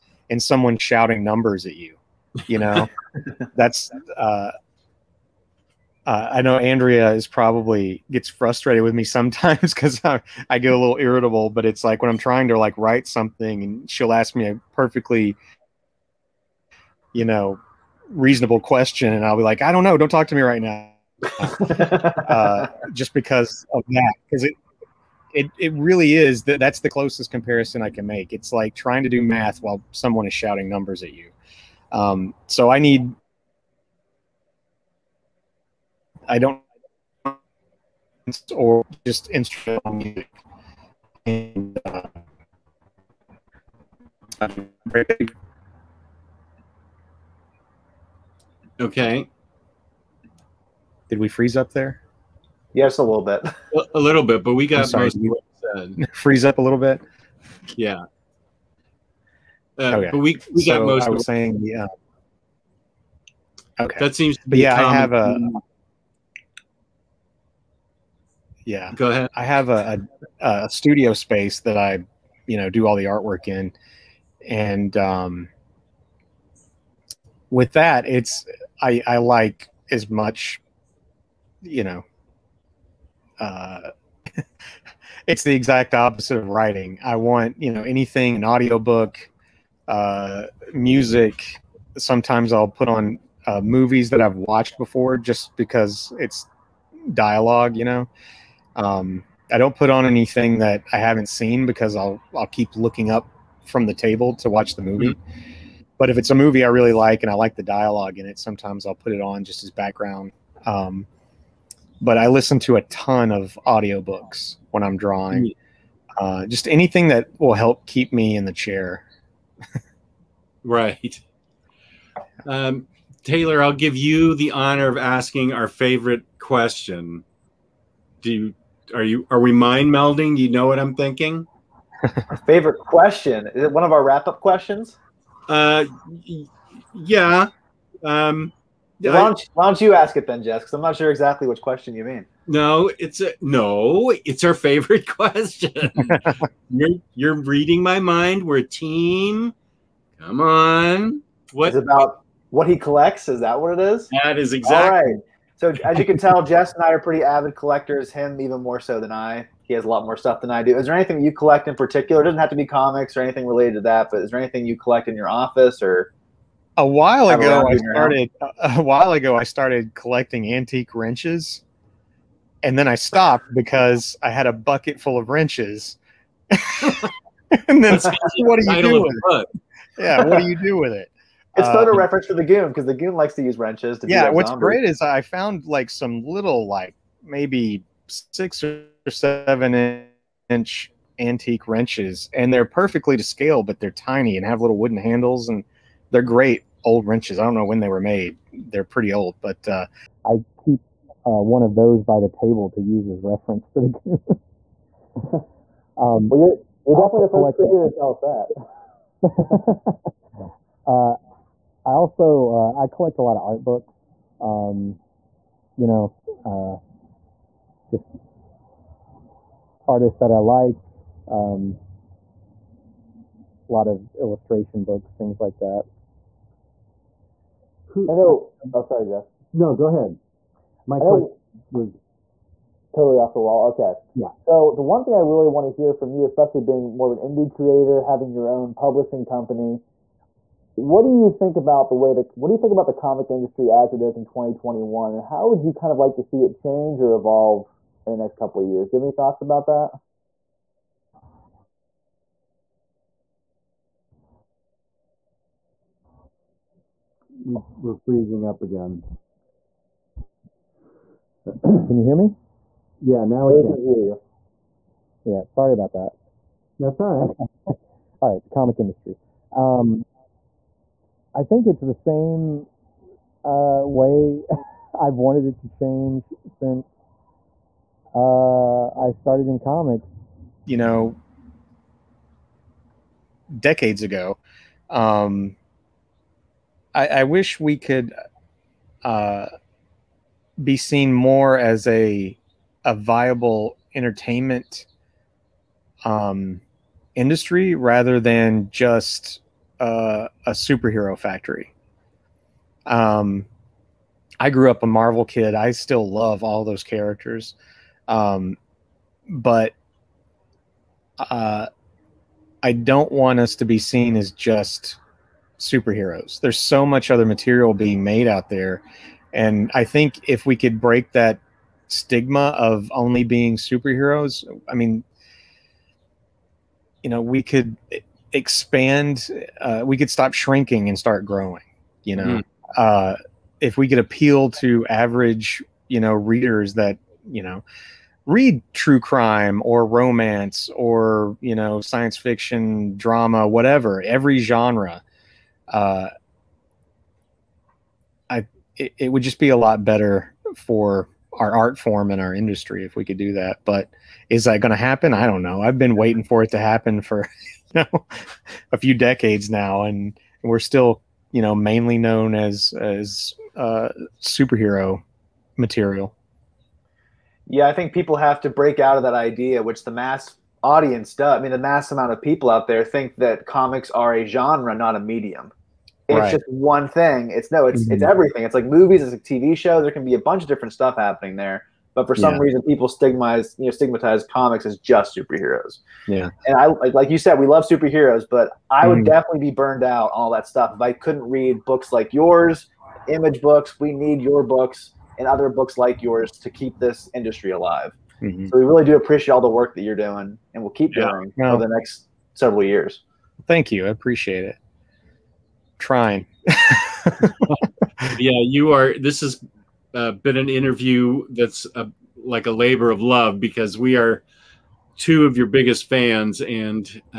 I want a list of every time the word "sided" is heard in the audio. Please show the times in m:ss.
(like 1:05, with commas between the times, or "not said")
not said.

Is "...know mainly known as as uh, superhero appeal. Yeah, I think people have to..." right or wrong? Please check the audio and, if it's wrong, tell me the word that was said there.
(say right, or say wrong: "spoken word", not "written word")
wrong: "material", not "appeal".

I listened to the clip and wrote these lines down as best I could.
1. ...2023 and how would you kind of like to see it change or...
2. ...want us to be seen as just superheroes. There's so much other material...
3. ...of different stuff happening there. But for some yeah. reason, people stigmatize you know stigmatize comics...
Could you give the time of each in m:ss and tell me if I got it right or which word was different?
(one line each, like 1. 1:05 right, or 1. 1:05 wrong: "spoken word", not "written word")
1. 4:04 wrong: "2021", not "2023"
2. 5:13 right
3. 6:20 right.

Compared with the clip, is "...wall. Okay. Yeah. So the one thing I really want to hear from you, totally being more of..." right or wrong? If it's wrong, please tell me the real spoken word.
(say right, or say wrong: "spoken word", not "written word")
wrong: "especially", not "totally".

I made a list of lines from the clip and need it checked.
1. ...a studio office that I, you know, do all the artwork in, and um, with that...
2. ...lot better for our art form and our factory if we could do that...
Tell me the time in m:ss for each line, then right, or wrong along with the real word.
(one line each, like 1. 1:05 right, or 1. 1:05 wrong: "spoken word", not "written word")
1. 1:10 wrong: "space", not "office"
2. 5:49 wrong: "industry", not "factory".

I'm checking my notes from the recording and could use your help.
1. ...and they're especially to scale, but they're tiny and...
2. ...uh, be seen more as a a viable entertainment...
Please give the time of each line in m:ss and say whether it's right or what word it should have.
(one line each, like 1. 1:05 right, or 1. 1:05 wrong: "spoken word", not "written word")
1. 3:12 wrong: "perfectly", not "especially"
2. 4:49 right.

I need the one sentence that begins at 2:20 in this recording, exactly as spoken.
Because I'm not sure exactly which question you mean.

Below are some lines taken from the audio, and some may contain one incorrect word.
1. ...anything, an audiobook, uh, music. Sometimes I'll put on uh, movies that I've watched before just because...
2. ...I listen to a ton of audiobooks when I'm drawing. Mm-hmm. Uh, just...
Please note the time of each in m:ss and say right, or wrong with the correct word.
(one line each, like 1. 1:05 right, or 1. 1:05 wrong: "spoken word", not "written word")
1. 1:27 right
2. 1:52 right.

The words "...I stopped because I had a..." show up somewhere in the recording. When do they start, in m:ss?
2:52.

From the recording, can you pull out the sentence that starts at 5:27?
It, expand uh, we could stop shrinking and start growing you know mm.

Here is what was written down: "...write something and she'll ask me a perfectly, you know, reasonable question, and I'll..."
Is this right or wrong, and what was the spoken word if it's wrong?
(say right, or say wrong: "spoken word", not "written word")
right.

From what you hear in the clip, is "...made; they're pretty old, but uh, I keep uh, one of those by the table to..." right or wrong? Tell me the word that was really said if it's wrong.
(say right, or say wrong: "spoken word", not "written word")
right.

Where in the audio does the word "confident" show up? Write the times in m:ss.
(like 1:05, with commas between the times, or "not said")
not said.